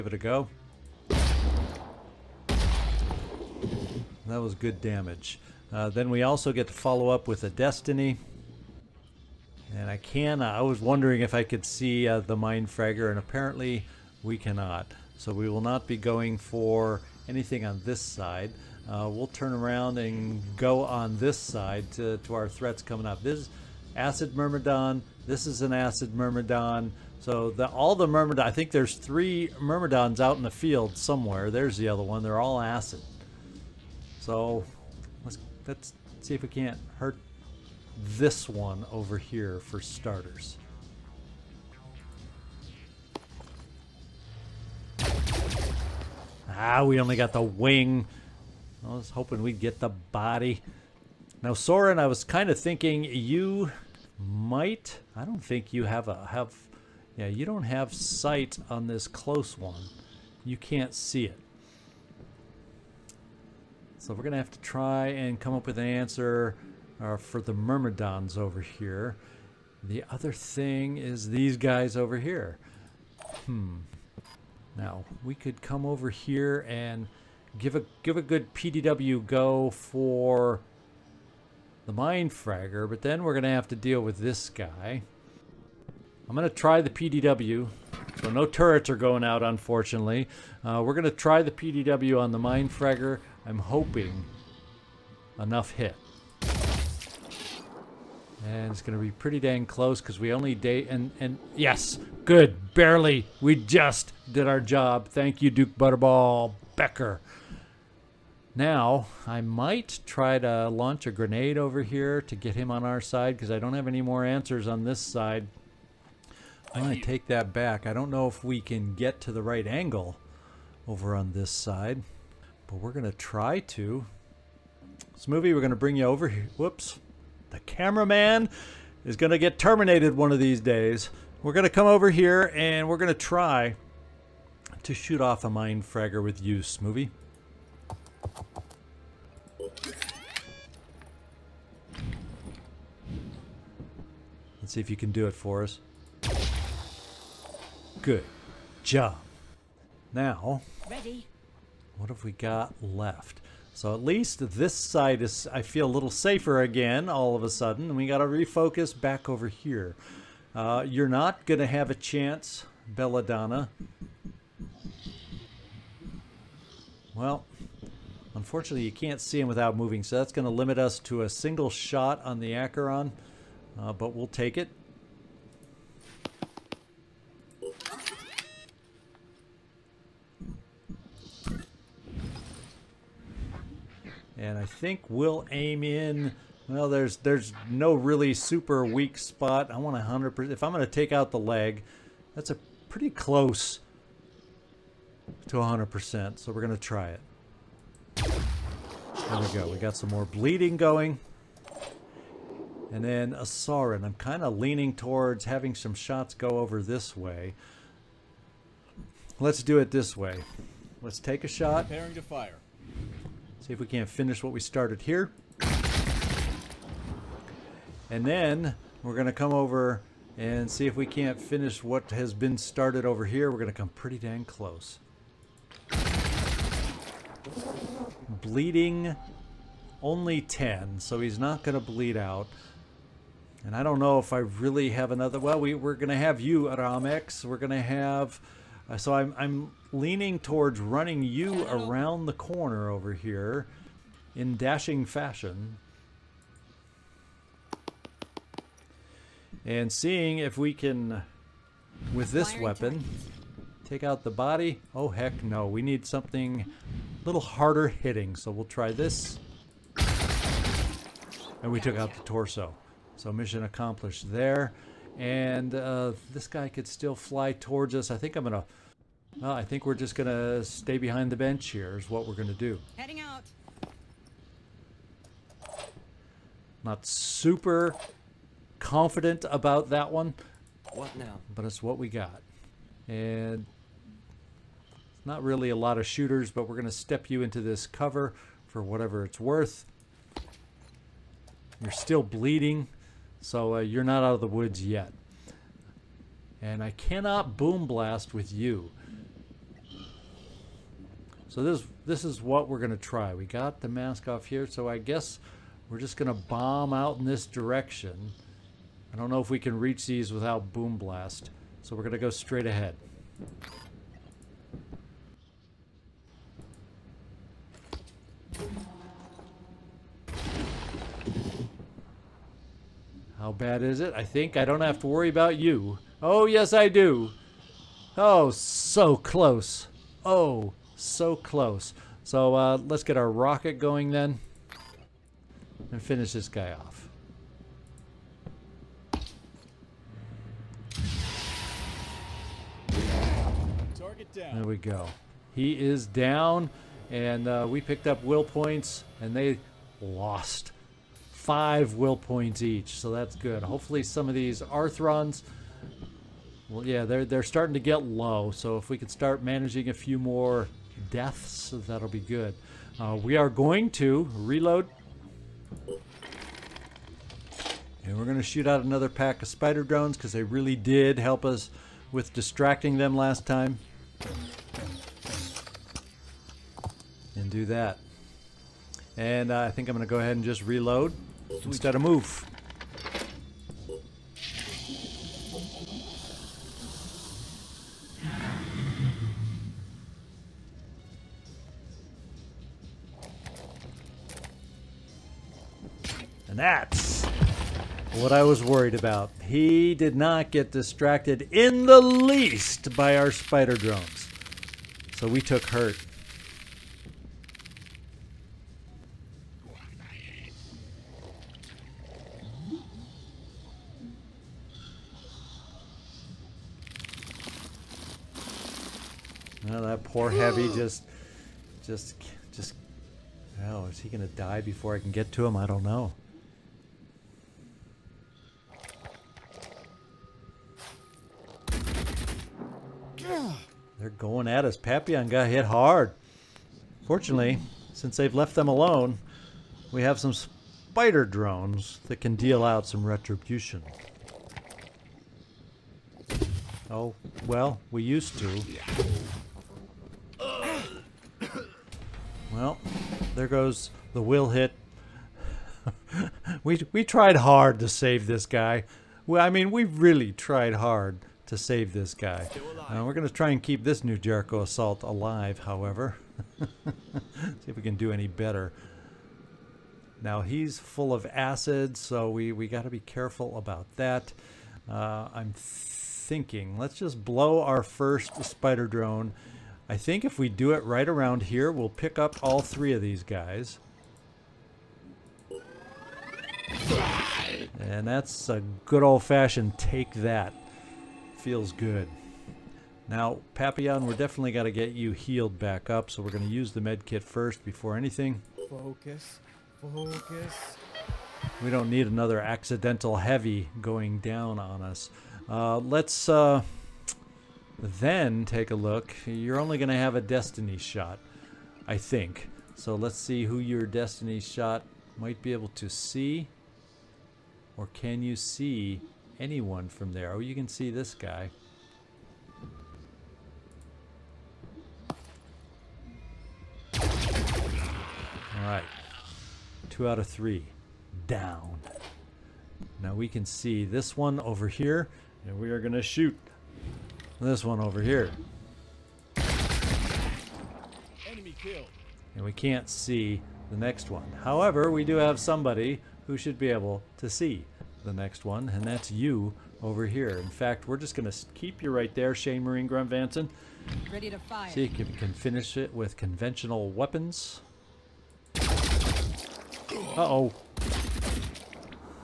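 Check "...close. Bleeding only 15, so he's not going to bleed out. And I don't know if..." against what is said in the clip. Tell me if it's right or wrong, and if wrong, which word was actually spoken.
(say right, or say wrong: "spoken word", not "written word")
wrong: "10", not "15".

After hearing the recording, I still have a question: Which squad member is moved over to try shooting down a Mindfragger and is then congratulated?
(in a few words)
Smoothie.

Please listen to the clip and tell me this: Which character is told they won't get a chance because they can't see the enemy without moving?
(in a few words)
Belladonna.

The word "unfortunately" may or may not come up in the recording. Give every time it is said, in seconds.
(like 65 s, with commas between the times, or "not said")
89 s, 168 s.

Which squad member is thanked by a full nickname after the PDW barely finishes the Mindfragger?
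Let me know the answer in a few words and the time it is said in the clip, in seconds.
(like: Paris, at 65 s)
Duke Butterball Becker, at 105 s.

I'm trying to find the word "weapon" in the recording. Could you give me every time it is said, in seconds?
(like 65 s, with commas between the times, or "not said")
252 s, 556 s.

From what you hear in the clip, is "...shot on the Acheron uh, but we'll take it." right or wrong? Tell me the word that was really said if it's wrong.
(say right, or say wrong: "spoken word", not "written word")
right.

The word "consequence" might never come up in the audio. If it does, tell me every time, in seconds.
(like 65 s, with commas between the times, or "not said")
not said.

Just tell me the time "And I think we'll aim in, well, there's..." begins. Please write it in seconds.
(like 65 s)
184 s.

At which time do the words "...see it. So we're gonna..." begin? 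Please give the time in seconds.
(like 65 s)
60 s.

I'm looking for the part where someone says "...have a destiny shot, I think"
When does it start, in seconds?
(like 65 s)
509 s.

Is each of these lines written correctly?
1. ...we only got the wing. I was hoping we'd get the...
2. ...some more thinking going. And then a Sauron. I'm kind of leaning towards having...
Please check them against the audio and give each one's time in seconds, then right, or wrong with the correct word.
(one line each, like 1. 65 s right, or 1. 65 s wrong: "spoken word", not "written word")
1. 46 s right
2. 199 s wrong: "bleeding", not "thinking".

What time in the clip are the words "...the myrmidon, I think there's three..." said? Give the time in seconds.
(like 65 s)
27 s.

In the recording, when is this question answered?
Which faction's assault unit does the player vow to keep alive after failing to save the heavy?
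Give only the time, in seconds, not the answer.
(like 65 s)
464 s.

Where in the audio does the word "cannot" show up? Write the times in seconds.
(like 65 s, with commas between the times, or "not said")
14 s, 296 s.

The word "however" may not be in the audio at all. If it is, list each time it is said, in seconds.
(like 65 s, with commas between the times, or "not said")
465 s, 544 s.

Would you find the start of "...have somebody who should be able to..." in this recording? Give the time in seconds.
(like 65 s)
545 s.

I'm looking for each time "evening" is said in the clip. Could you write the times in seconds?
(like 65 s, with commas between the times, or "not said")
not said.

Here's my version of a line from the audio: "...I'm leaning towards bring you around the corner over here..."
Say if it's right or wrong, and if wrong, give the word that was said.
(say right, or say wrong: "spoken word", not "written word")
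wrong: "running", not "bring".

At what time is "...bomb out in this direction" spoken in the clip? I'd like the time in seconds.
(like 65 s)
306 s.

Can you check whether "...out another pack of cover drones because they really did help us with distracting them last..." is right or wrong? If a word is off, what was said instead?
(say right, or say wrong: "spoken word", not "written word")
wrong: "spider", not "cover".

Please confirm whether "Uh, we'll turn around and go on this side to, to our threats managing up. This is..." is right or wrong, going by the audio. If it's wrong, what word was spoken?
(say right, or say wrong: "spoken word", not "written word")
wrong: "coming", not "managing".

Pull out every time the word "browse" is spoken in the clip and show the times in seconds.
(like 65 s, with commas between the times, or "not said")
not said.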